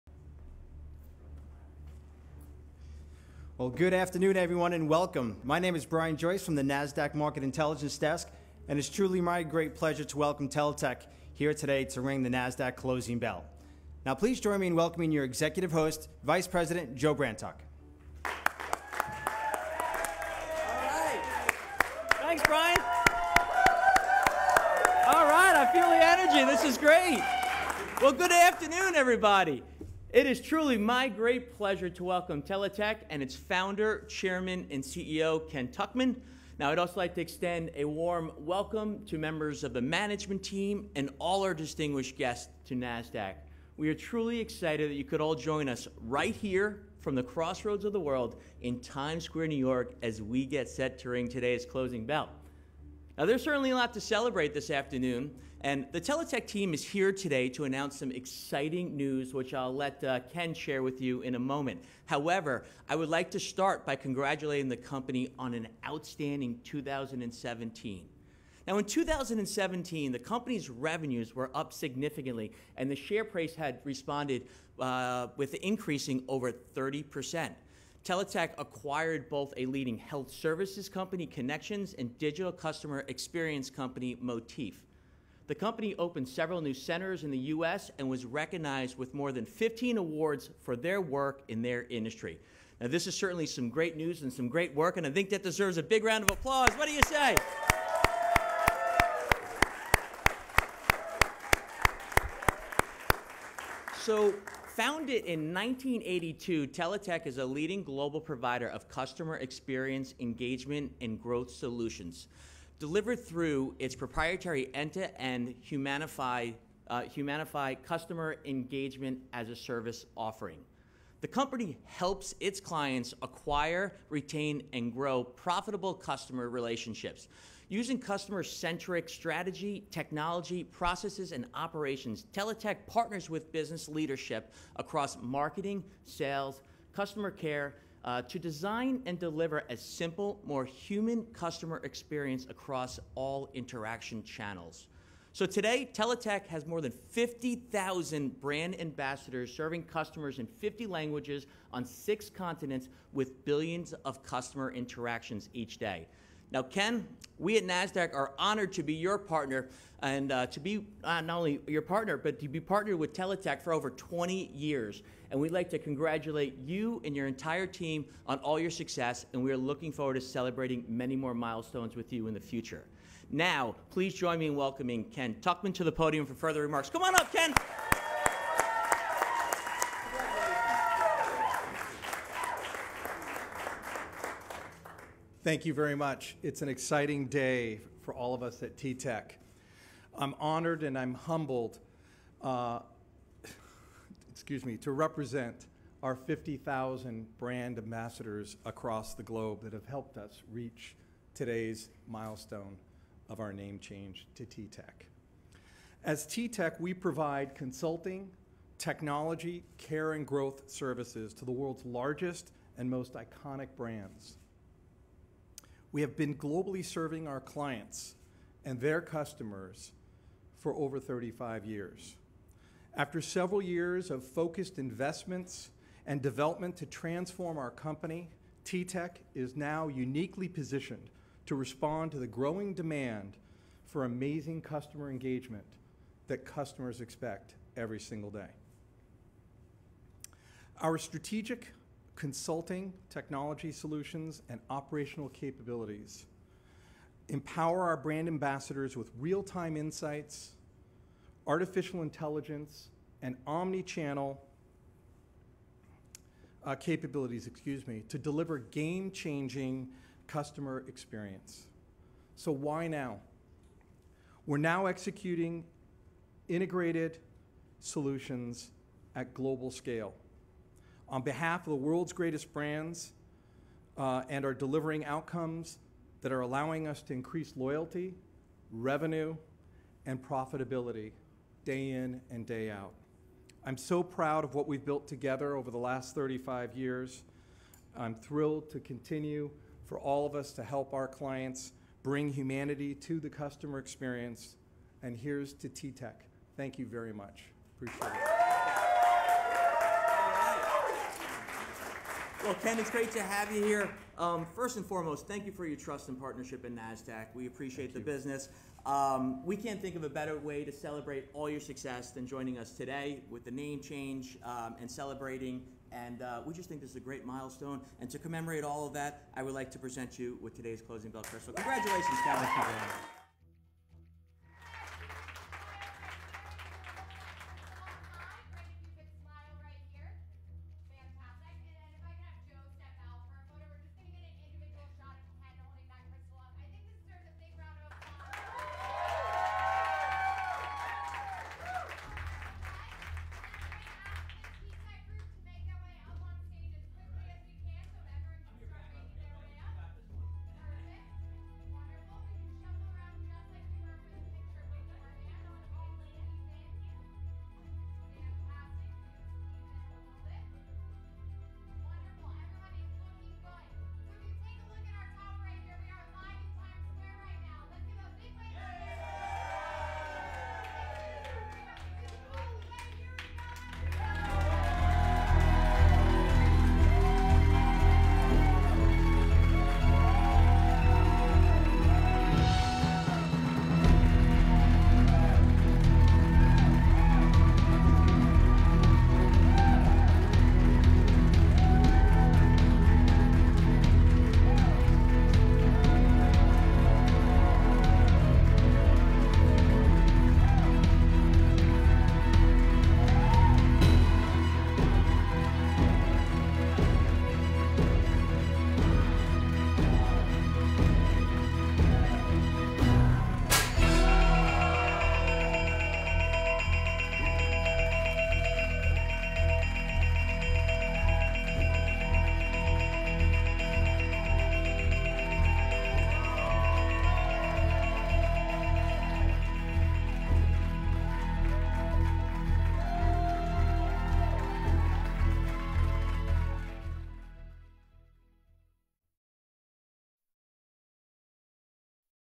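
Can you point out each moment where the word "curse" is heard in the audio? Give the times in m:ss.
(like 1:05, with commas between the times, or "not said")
5:21.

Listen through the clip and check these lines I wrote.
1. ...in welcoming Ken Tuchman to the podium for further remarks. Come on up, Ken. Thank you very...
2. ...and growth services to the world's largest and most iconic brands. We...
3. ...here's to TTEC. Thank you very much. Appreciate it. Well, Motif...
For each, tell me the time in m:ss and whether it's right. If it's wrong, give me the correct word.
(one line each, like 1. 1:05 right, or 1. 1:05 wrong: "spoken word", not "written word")
1. 2:54 right
2. 3:30 right
3. 4:55 wrong: "Ken", not "Motif".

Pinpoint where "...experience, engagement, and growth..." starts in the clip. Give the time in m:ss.
1:49.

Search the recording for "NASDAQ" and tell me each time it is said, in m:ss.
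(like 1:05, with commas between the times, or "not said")
0:06, 0:12, 0:42, 2:37, 5:06.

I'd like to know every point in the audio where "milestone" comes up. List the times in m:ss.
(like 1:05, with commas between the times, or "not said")
2:51, 3:22, 5:17.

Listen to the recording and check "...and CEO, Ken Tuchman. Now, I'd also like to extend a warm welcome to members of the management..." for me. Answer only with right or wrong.
right.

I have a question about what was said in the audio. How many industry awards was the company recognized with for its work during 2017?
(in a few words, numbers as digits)
more than 15.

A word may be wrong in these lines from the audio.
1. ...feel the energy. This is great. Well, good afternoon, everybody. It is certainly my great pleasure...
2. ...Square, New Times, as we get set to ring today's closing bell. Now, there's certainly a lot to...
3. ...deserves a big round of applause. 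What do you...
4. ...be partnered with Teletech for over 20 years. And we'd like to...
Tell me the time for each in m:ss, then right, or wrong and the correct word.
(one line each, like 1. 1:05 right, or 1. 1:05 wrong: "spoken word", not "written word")
1. 0:25 wrong: "truly", not "certainly"
2. 0:49 wrong: "York", not "Times"
3. 1:35 right
4. 2:42 right.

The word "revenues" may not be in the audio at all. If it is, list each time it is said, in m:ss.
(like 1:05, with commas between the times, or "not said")
1:10, 4:38.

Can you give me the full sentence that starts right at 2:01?
The company helps its clients acquire, retain, and grow profitable customer relationships using customer centric strategy, technology, processes, and operations.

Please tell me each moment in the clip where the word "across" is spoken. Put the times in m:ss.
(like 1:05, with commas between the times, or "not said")
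2:14, 2:22, 3:18.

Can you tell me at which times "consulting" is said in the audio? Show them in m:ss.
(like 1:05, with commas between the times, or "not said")
3:27, 4:02.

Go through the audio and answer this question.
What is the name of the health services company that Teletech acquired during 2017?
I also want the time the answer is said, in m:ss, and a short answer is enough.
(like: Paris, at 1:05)
Connextions, at 1:21.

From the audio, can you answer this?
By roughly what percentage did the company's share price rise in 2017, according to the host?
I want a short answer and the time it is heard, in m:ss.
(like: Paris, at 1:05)
over 30 percent, at 1:16.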